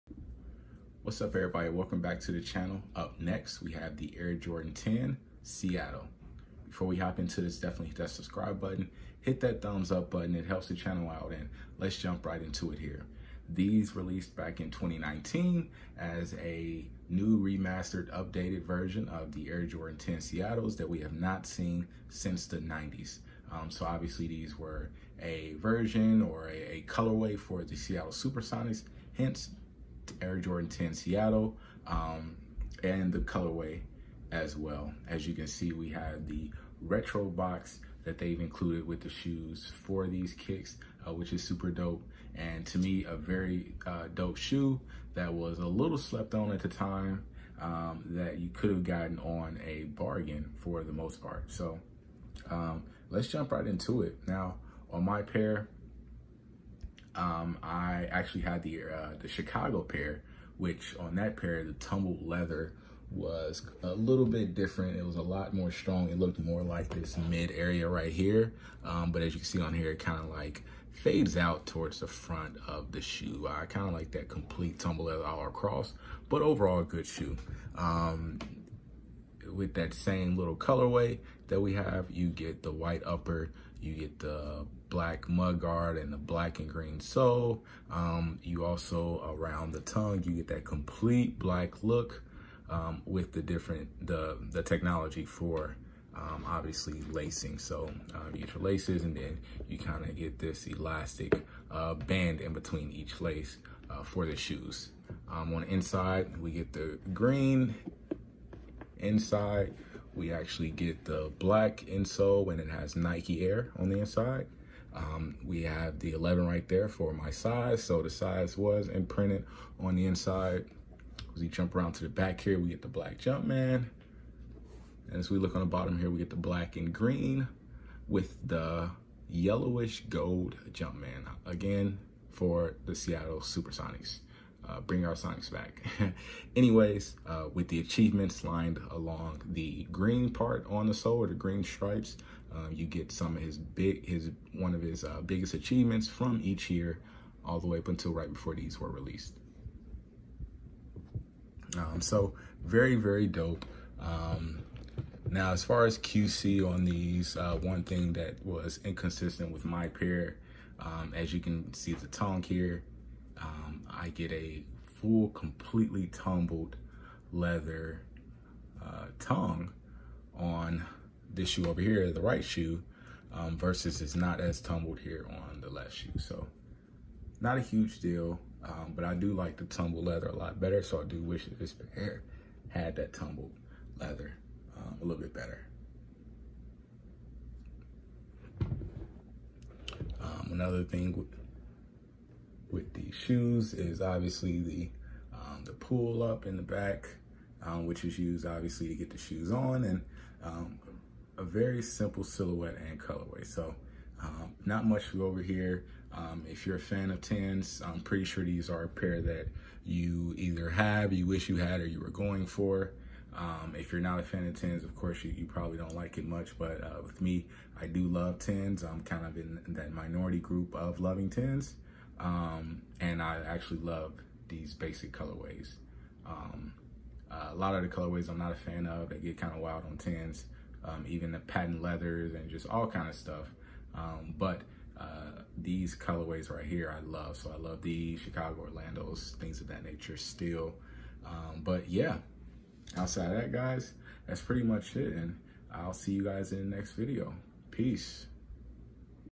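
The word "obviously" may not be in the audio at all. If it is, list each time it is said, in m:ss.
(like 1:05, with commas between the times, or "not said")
0:23, 1:36, 3:14, 3:18.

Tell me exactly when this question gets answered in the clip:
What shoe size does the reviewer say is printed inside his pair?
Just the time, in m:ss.
1:56.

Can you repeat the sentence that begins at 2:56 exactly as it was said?
So not a huge deal, um, but I do like the tumbled leather a lot better.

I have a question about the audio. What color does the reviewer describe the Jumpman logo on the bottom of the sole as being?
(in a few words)
Yellowish gold.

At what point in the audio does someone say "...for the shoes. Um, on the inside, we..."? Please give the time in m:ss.
1:44.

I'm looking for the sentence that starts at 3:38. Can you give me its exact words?
I'm kind of in that minority group of loving tens.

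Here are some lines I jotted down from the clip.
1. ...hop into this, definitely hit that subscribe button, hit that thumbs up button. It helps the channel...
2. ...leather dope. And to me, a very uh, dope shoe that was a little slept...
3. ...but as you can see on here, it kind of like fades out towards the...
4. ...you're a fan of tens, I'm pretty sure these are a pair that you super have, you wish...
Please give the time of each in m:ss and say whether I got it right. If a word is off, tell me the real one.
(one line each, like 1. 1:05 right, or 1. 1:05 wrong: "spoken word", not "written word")
1. 0:06 right
2. 0:41 wrong: "super", not "leather"
3. 1:09 right
4. 3:26 wrong: "either", not "super".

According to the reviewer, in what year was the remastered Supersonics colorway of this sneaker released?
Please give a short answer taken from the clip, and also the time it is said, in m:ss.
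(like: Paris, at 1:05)
2019, at 0:14.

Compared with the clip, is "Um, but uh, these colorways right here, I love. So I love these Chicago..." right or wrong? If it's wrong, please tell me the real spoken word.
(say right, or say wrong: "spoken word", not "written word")
right.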